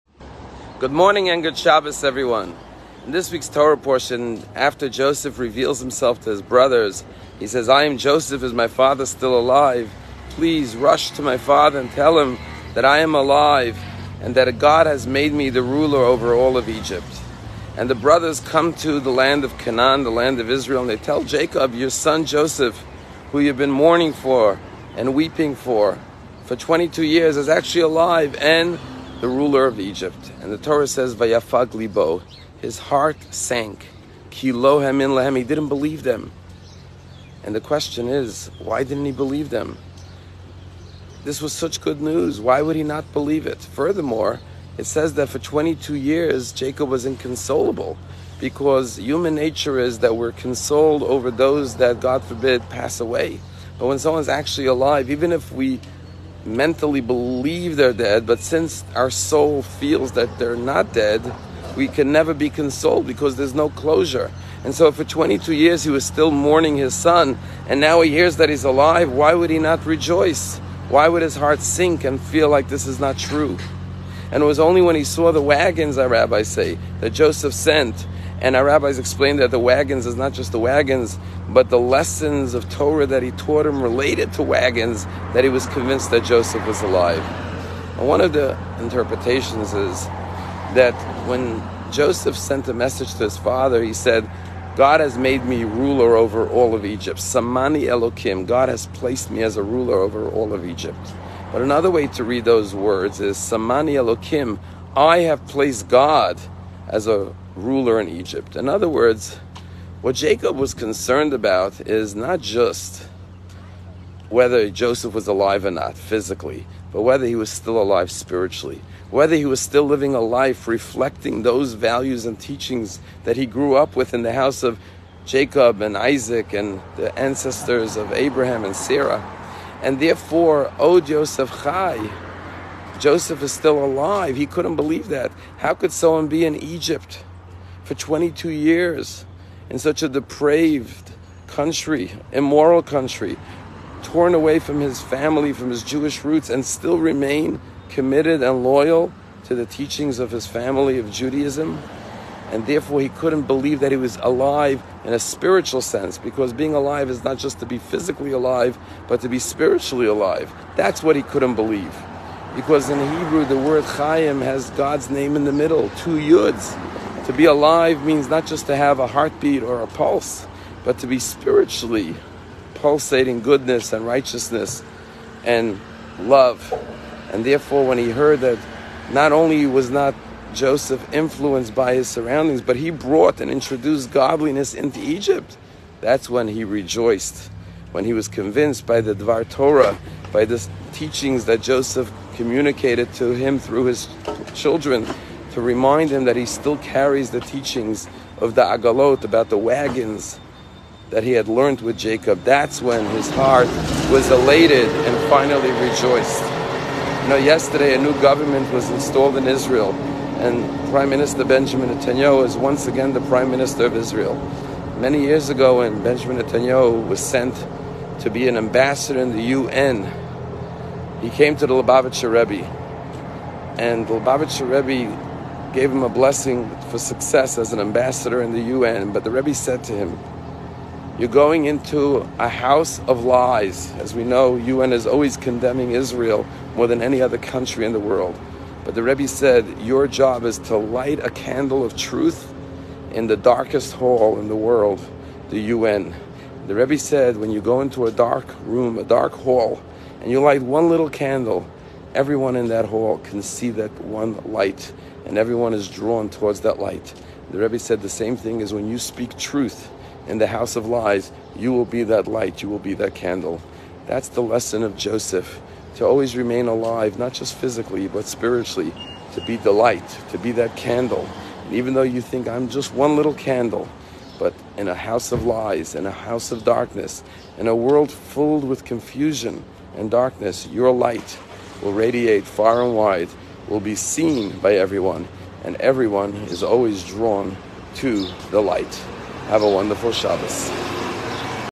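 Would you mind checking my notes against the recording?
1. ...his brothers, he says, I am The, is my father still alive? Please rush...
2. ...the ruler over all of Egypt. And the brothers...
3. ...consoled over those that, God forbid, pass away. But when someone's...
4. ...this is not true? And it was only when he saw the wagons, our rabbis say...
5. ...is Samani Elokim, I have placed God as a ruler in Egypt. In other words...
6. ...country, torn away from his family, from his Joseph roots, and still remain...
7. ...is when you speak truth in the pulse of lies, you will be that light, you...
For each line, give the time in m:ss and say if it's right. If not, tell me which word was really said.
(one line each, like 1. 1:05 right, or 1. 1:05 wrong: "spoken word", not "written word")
1. 0:06 wrong: "Joseph", not "The"
2. 0:15 right
3. 0:50 right
4. 1:12 right
5. 1:43 right
6. 2:22 wrong: "Jewish", not "Joseph"
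7. 4:18 wrong: "house", not "pulse".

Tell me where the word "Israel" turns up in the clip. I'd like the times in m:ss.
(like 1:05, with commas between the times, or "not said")
0:20, 3:29, 3:33, 3:55.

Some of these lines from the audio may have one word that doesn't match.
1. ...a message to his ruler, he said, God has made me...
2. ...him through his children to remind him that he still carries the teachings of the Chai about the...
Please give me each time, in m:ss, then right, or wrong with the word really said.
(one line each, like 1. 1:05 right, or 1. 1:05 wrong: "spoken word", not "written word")
1. 1:32 wrong: "father", not "ruler"
2. 3:13 wrong: "Agalot", not "Chai".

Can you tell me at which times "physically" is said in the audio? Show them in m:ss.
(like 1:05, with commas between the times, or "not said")
1:55, 2:37, 4:27.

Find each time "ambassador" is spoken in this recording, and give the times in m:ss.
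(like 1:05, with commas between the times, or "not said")
3:38, 3:47.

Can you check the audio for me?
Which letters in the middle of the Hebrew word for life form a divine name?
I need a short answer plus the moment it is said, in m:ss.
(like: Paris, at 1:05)
Two yuds, at 2:45.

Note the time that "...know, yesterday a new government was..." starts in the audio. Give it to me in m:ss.
3:27.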